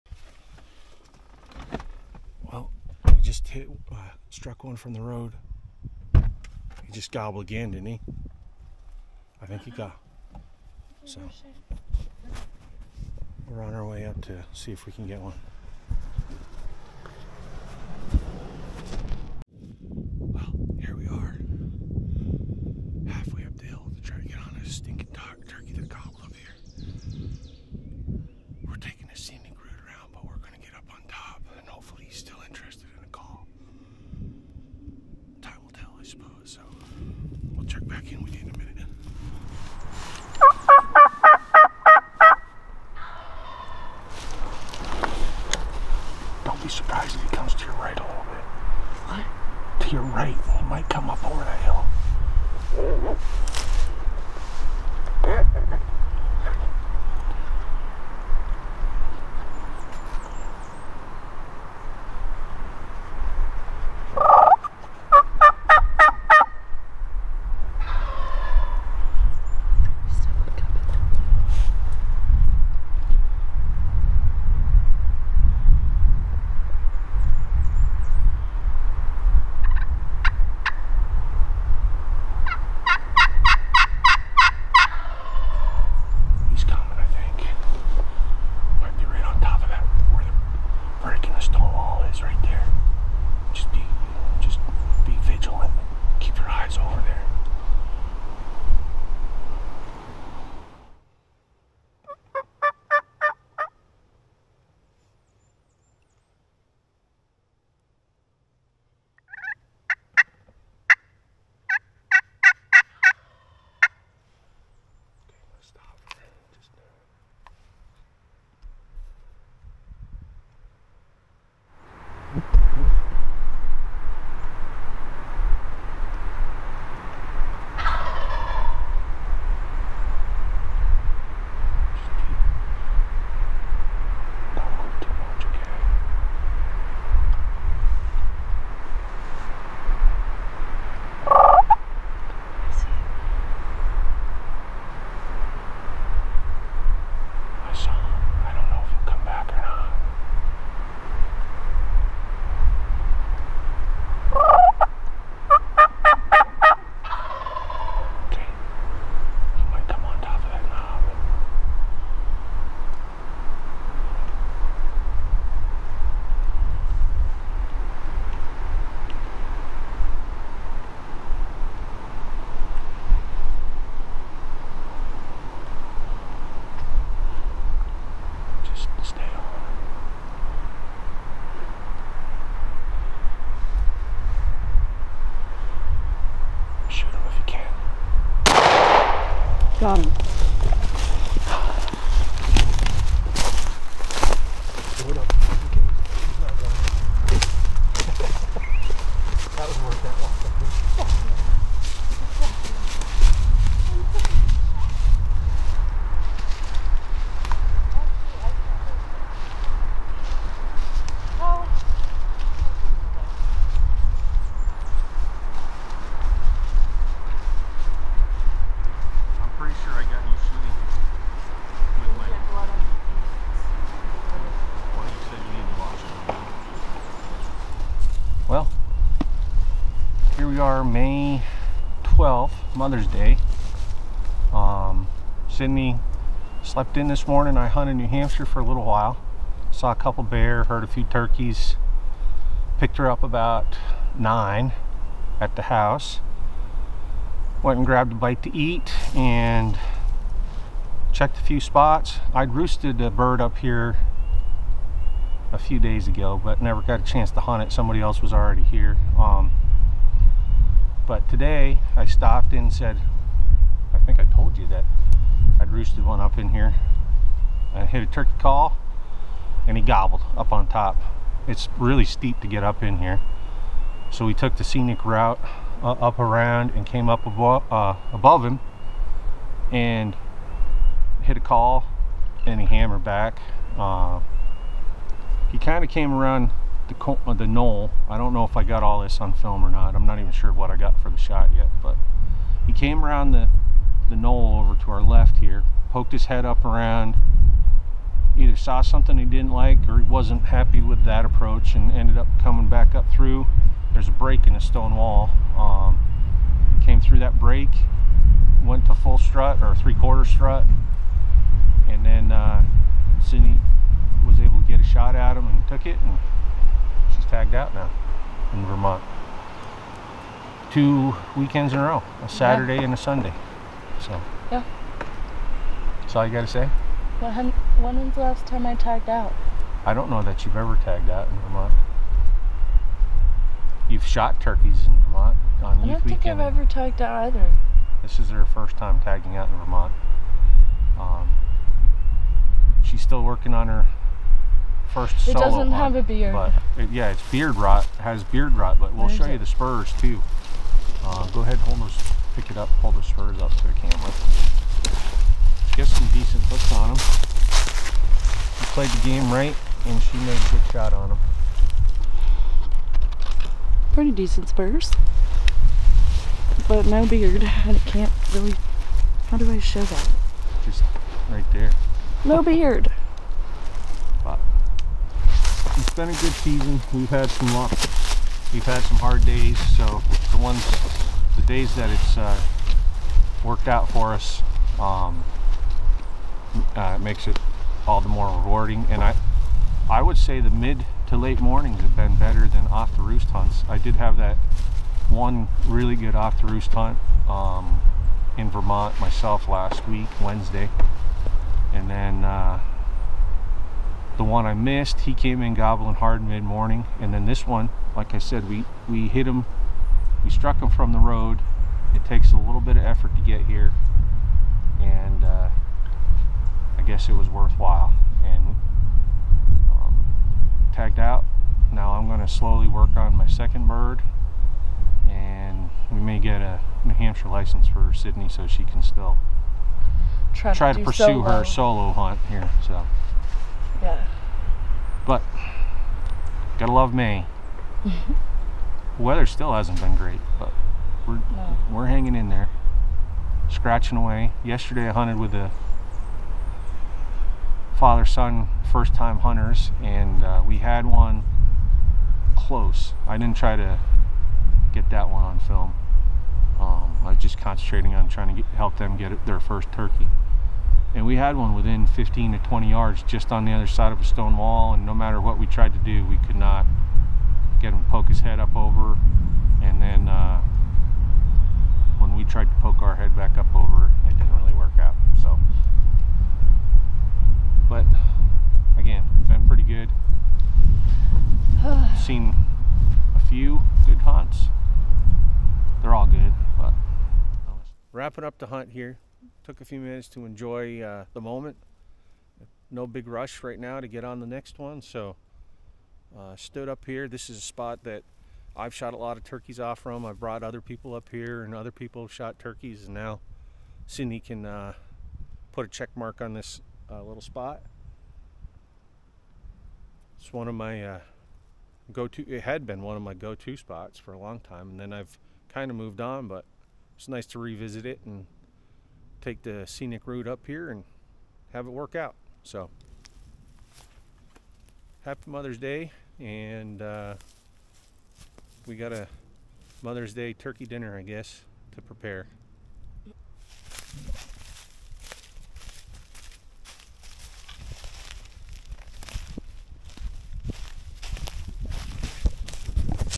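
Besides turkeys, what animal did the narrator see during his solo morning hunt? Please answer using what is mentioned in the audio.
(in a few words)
Bear.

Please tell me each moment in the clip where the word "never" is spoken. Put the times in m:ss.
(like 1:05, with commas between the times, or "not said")
4:16.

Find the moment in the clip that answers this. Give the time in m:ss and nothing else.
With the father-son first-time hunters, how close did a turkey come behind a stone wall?
7:41.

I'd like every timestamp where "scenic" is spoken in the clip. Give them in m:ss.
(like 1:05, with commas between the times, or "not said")
4:34, 8:39.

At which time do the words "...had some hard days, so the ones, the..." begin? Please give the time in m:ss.
6:18.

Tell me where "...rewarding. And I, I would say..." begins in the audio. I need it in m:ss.
6:28.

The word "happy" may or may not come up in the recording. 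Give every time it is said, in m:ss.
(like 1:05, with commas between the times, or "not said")
5:00, 8:45.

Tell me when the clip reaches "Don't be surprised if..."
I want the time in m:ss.
0:46.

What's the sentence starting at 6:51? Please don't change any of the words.
It takes a little bit of effort to get here.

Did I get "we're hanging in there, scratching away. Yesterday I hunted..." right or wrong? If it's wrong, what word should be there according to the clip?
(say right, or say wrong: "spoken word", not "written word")
right.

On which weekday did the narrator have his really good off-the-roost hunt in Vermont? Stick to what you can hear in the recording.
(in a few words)
Wednesday.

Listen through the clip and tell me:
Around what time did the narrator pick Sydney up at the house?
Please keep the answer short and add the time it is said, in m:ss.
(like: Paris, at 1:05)
9, at 4:04.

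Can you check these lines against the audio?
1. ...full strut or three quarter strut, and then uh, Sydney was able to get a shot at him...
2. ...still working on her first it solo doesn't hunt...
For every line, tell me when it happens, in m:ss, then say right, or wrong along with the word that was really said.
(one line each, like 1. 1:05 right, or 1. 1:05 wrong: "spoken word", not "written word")
1. 5:08 right
2. 5:43 right.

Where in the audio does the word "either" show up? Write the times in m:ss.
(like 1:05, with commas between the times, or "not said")
4:58, 5:37.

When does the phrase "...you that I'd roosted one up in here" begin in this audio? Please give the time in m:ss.
4:24.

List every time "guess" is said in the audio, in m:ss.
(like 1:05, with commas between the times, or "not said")
6:56, 8:51.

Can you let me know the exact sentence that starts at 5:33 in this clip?
You've shot turkeys in Vermont on I youth weekend.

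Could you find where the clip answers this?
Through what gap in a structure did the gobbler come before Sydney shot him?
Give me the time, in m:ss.
5:04.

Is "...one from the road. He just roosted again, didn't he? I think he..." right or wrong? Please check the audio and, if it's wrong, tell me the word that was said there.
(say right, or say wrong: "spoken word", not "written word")
wrong: "gobbled", not "roosted".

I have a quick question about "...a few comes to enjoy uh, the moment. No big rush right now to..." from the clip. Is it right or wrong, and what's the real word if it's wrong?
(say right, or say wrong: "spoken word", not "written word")
wrong: "minutes", not "comes".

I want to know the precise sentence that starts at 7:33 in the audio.
I didn't try to get that one on film.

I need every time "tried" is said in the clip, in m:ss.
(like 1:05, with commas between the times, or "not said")
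7:45, 7:52.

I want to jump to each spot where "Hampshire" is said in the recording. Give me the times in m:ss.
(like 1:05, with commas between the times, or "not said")
3:58, 7:06.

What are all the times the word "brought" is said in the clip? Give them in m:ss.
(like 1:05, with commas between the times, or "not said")
8:20.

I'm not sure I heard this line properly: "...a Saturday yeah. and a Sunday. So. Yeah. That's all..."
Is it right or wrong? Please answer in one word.
right.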